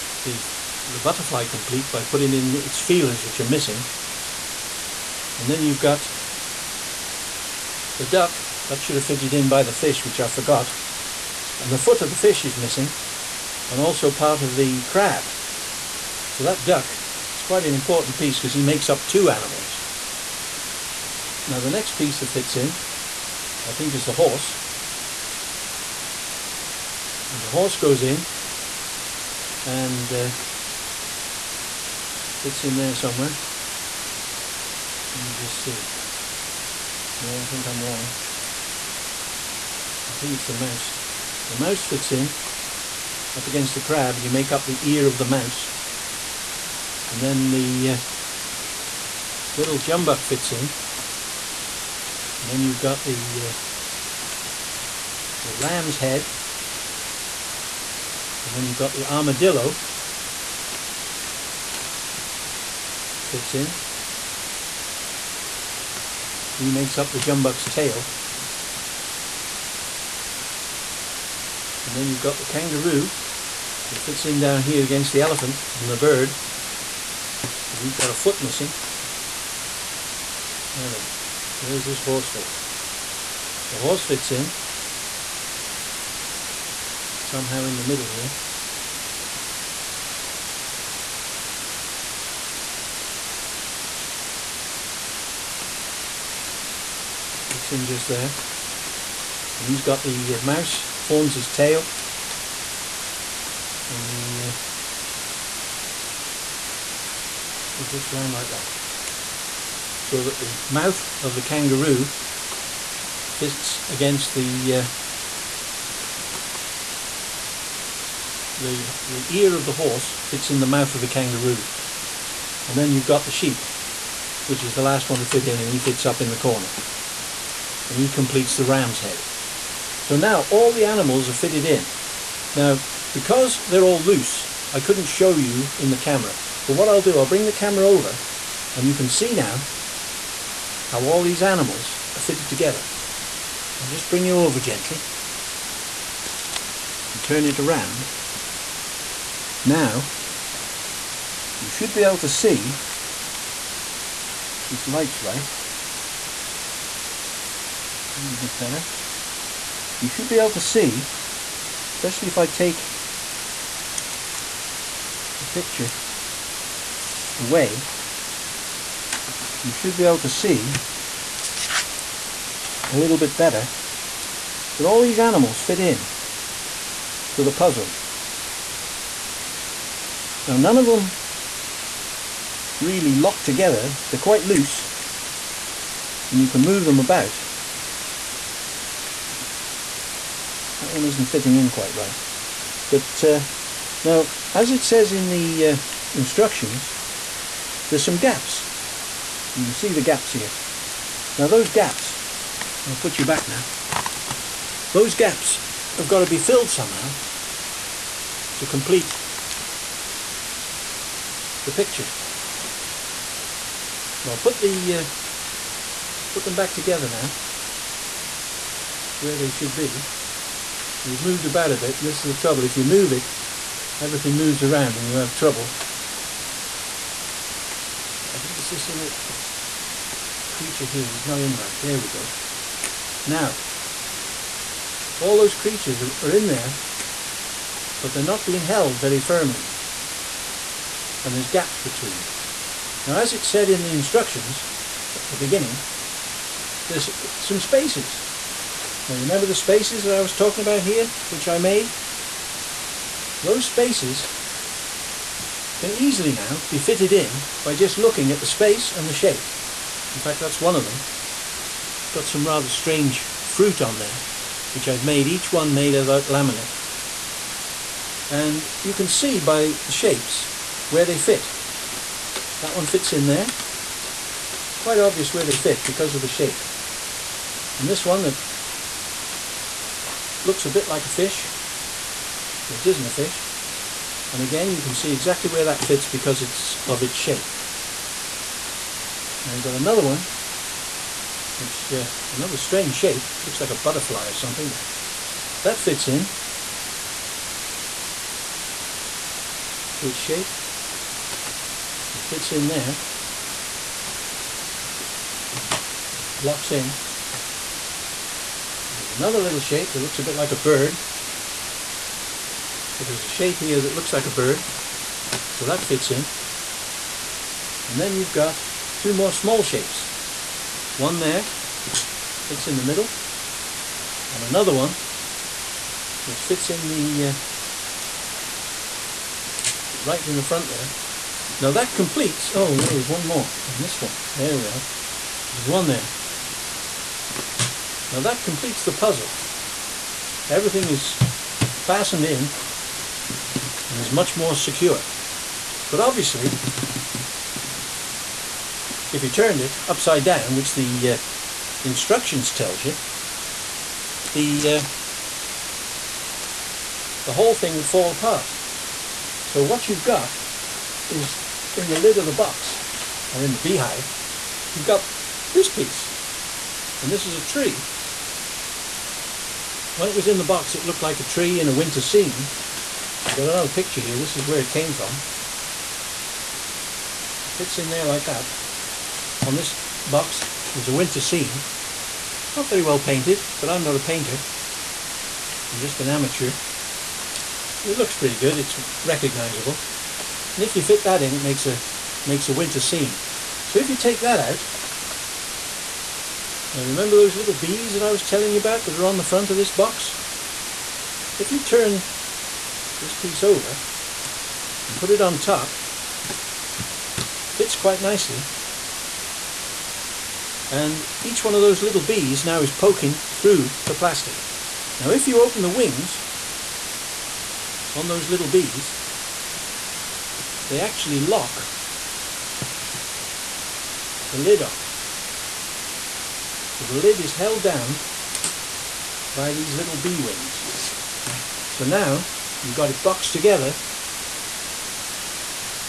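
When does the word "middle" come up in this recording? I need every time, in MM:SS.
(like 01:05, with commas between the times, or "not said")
01:27, 05:22.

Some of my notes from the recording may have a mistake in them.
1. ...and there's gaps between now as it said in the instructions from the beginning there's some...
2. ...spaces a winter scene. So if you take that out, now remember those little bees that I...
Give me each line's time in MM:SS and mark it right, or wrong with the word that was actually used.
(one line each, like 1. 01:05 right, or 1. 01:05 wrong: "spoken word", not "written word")
1. 04:01 right
2. 06:32 wrong: "makes", not "spaces".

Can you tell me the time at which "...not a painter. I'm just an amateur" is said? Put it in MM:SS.
06:23.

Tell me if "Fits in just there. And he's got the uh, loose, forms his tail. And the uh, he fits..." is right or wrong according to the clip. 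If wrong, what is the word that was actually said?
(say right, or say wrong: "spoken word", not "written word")
wrong: "mouse", not "loose".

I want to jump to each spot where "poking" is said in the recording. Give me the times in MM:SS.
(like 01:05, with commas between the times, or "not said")
06:52.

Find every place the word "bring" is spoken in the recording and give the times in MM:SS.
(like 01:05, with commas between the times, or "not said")
02:17, 02:24.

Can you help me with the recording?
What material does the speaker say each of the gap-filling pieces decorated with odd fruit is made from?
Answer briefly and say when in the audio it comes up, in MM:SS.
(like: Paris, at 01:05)
Laminate, at 04:26.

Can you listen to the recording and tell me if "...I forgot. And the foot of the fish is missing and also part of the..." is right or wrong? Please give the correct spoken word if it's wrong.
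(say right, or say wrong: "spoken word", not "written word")
right.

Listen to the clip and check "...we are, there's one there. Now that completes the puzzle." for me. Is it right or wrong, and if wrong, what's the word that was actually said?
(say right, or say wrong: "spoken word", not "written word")
right.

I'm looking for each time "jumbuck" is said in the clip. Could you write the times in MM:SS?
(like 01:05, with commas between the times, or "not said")
00:49, 01:07.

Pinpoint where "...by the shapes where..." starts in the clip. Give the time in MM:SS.
04:29.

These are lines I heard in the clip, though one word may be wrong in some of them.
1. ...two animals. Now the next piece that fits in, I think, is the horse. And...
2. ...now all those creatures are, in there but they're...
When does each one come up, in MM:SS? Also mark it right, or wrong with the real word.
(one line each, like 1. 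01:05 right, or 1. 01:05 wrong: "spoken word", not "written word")
1. 00:19 right
2. 03:53 right.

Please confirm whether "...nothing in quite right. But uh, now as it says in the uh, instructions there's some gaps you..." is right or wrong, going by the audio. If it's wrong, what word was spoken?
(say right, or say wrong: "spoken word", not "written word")
wrong: "fitting", not "nothing".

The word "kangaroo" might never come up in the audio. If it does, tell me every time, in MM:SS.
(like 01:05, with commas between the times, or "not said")
01:12, 01:51, 02:01.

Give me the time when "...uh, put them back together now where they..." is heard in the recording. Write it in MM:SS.
03:34.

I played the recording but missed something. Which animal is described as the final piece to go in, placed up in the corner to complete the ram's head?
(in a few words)
Sheep.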